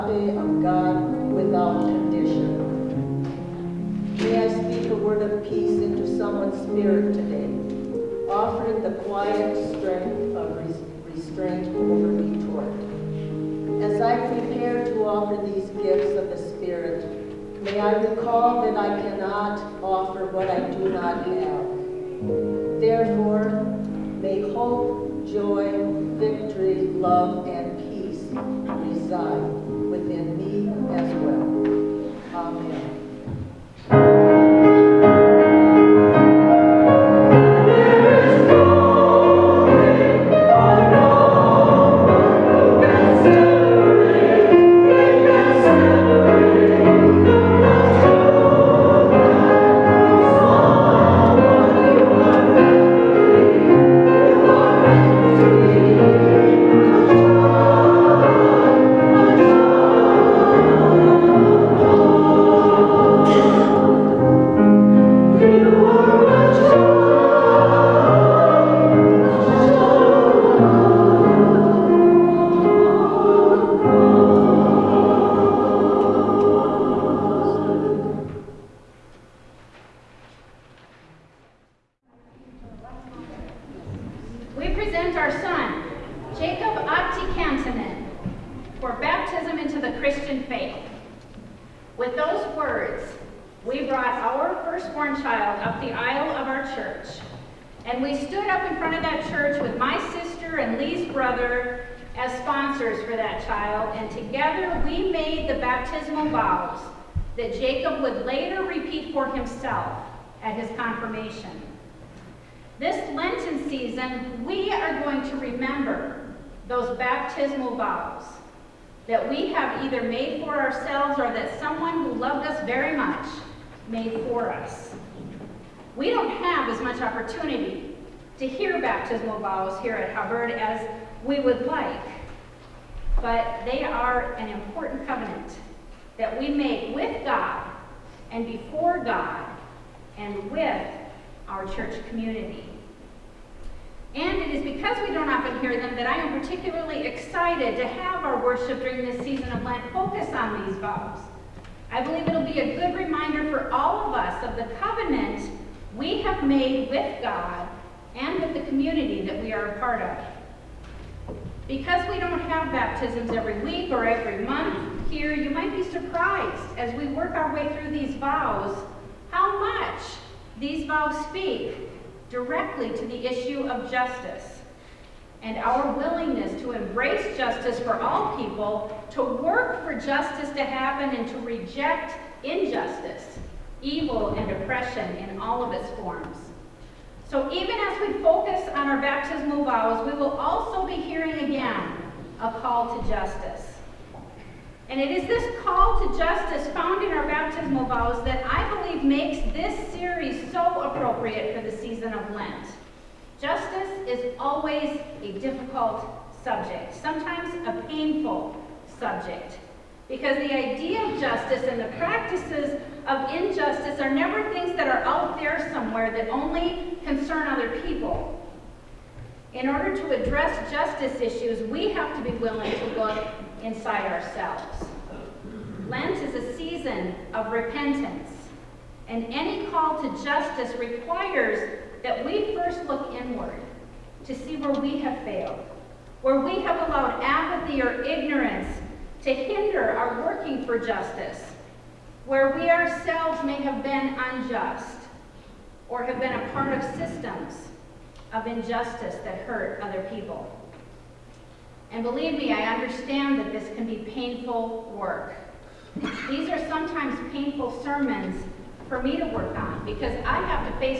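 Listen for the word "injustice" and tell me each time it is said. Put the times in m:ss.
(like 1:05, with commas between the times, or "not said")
3:02, 3:33, 4:08.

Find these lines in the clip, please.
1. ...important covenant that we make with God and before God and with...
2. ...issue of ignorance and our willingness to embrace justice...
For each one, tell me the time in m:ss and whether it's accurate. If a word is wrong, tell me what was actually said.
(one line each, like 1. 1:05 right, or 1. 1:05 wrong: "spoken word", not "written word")
1. 2:14 right
2. 2:53 wrong: "justice", not "ignorance".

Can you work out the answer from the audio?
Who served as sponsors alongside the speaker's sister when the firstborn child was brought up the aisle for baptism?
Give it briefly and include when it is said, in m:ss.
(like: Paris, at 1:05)
Lee's brother, at 1:40.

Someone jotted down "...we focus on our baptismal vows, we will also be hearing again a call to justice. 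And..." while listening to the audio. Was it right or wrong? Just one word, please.
right.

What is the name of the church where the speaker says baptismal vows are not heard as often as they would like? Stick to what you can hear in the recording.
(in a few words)
Hubbard.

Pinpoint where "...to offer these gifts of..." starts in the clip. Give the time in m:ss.
0:14.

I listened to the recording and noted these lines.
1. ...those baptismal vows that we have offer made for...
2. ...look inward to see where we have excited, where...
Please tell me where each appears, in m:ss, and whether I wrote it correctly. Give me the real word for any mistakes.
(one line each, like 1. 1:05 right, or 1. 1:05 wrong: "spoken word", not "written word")
1. 1:56 wrong: "either", not "offer"
2. 3:52 wrong: "failed", not "excited".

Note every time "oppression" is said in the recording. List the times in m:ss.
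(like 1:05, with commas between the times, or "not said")
3:04.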